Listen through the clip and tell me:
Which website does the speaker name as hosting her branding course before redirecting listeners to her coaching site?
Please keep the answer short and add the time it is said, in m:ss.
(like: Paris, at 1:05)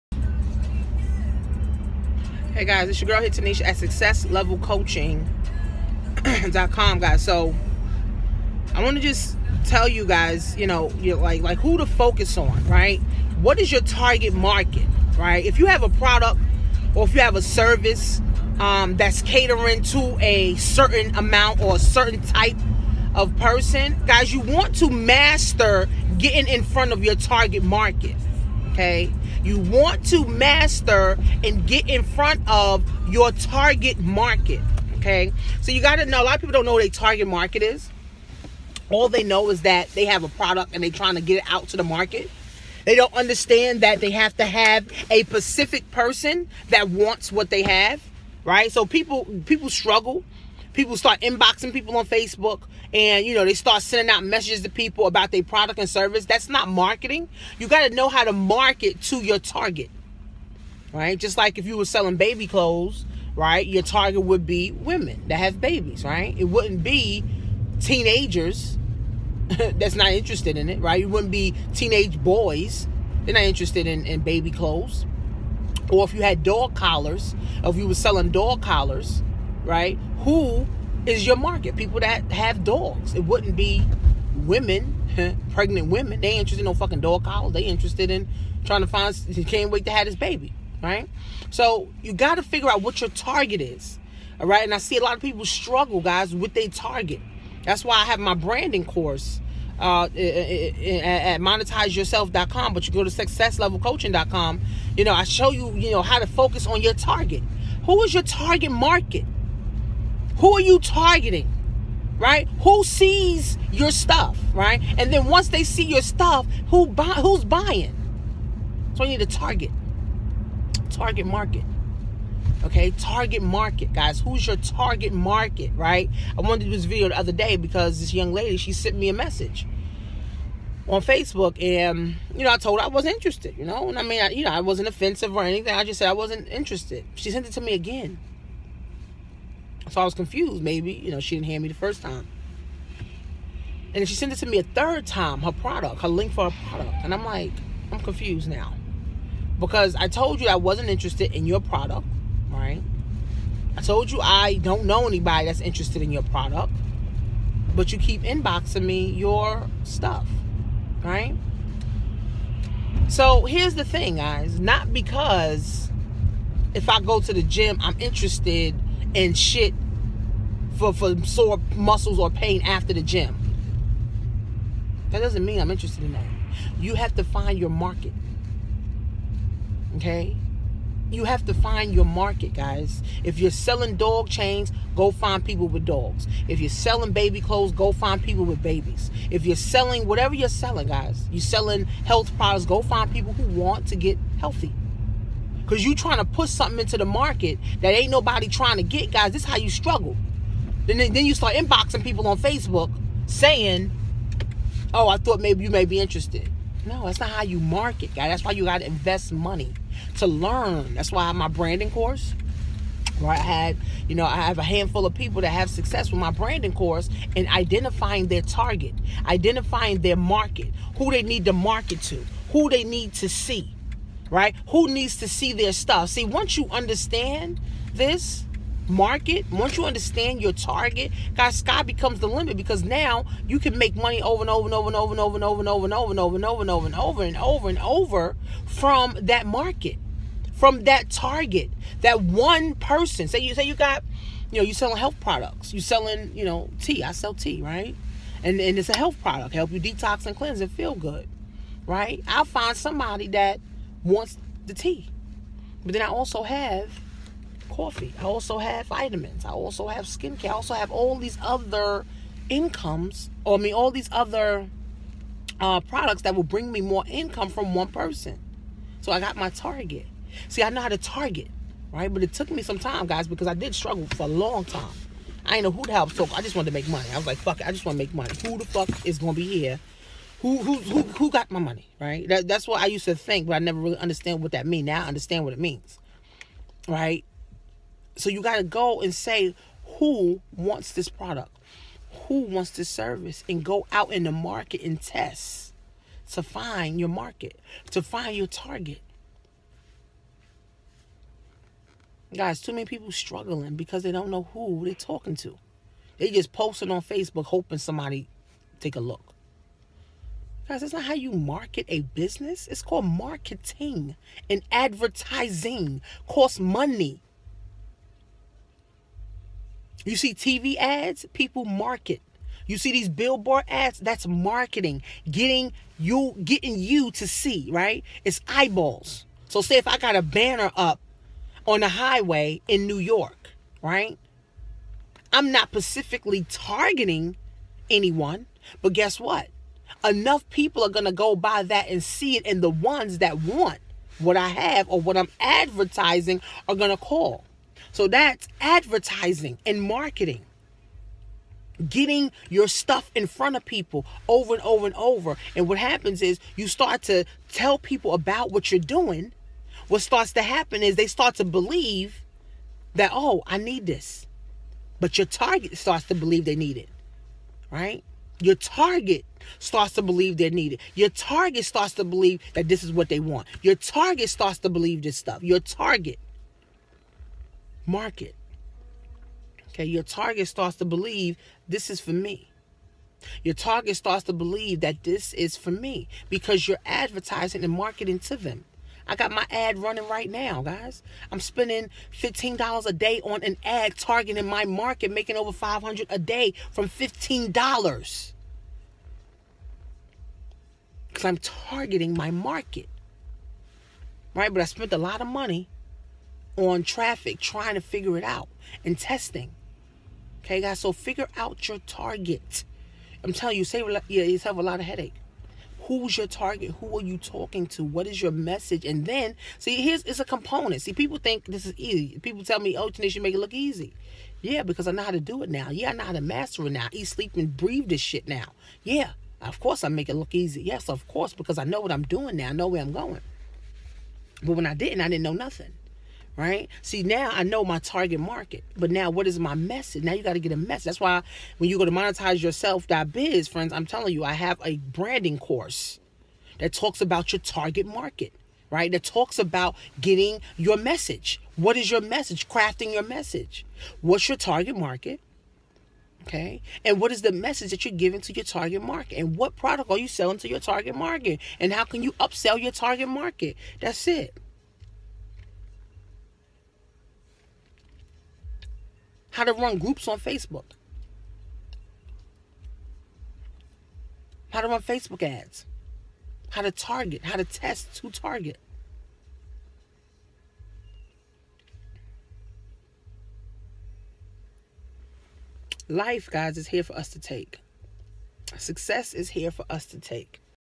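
monetizeyourself.com, at 1:41.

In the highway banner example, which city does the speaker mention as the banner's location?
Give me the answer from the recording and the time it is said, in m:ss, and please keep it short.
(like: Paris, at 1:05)
New York, at 5:32.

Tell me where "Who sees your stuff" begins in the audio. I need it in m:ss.
1:52.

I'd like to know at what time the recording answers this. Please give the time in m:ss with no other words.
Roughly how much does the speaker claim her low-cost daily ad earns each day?
6:35.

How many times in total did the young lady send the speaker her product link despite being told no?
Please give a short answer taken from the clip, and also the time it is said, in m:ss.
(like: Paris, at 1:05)
3, at 2:24.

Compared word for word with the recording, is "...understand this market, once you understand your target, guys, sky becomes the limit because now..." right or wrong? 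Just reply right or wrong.
right.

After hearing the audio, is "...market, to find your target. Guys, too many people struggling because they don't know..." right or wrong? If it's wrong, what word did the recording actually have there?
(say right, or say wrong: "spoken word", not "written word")
right.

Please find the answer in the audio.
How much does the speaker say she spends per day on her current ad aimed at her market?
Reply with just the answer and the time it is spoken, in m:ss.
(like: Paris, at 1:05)
$15, at 6:32.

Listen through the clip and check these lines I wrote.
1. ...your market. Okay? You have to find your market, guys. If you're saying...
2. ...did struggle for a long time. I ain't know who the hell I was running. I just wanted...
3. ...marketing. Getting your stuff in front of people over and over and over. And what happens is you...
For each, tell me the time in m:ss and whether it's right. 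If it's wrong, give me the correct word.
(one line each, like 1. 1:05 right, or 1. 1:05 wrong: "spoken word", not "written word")
1. 2:57 wrong: "selling", not "saying"
2. 4:33 wrong: "talking", not "running"
3. 5:49 right.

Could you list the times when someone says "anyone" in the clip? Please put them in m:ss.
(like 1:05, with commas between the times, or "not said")
5:37.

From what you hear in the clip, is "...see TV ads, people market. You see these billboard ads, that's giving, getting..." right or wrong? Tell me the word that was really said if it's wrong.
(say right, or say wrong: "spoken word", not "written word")
wrong: "marketing", not "giving".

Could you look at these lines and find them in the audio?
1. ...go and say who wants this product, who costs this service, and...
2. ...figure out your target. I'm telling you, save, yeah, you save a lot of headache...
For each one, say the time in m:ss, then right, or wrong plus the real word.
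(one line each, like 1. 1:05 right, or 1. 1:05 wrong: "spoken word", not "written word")
1. 4:48 wrong: "wants", not "costs"
2. 6:50 right.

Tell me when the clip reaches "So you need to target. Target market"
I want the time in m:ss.
1:58.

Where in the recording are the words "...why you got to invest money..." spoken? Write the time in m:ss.
3:28.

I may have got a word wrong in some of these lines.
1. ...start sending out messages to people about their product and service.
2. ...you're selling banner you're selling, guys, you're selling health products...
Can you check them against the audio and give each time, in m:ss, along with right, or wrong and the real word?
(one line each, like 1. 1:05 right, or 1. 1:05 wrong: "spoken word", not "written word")
1. 0:53 right
2. 3:09 wrong: "whatever", not "banner".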